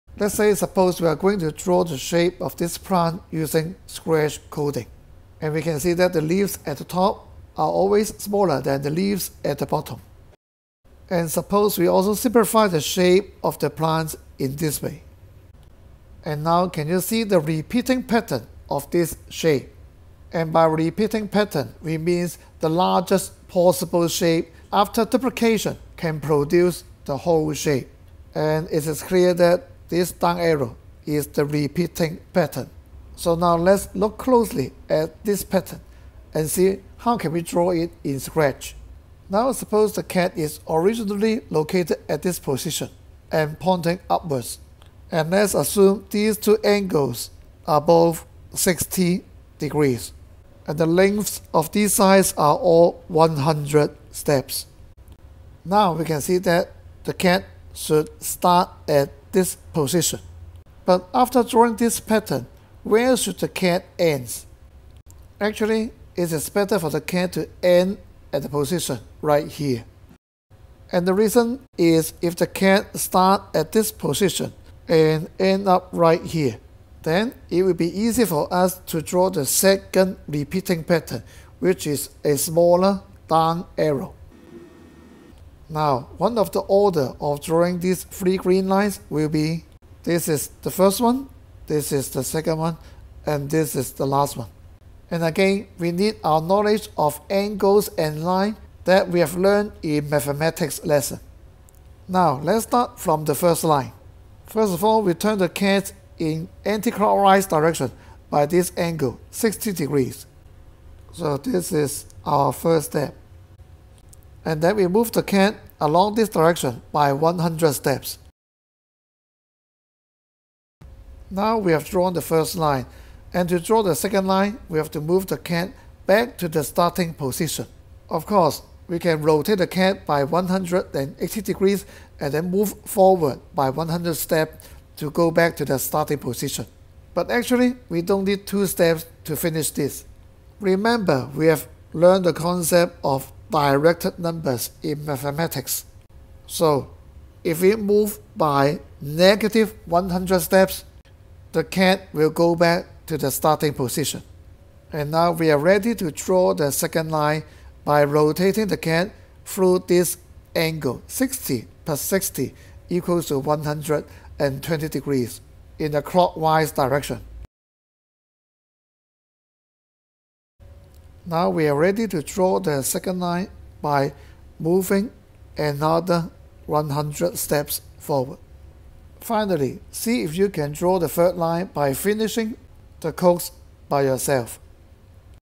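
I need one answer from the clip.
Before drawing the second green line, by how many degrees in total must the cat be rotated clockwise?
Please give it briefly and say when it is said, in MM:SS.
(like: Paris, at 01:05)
120 degrees, at 02:43.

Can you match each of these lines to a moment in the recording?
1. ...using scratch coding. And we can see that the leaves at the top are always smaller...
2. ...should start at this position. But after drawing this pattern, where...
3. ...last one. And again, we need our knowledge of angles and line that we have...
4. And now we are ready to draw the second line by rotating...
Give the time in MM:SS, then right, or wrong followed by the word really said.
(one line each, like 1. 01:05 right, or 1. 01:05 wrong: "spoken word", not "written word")
1. 00:03 right
2. 00:57 right
3. 01:34 right
4. 02:34 right.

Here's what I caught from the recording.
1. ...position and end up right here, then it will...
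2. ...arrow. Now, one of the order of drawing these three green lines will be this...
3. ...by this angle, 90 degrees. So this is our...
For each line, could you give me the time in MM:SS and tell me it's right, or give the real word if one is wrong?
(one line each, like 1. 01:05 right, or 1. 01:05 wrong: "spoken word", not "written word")
1. 01:13 right
2. 01:23 right
3. 01:48 wrong: "60", not "90".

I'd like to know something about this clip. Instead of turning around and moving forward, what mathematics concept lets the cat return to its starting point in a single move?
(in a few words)
directed numbers.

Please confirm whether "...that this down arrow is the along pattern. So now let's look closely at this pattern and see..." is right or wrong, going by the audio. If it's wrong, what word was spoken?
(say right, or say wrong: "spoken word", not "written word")
wrong: "repeating", not "along".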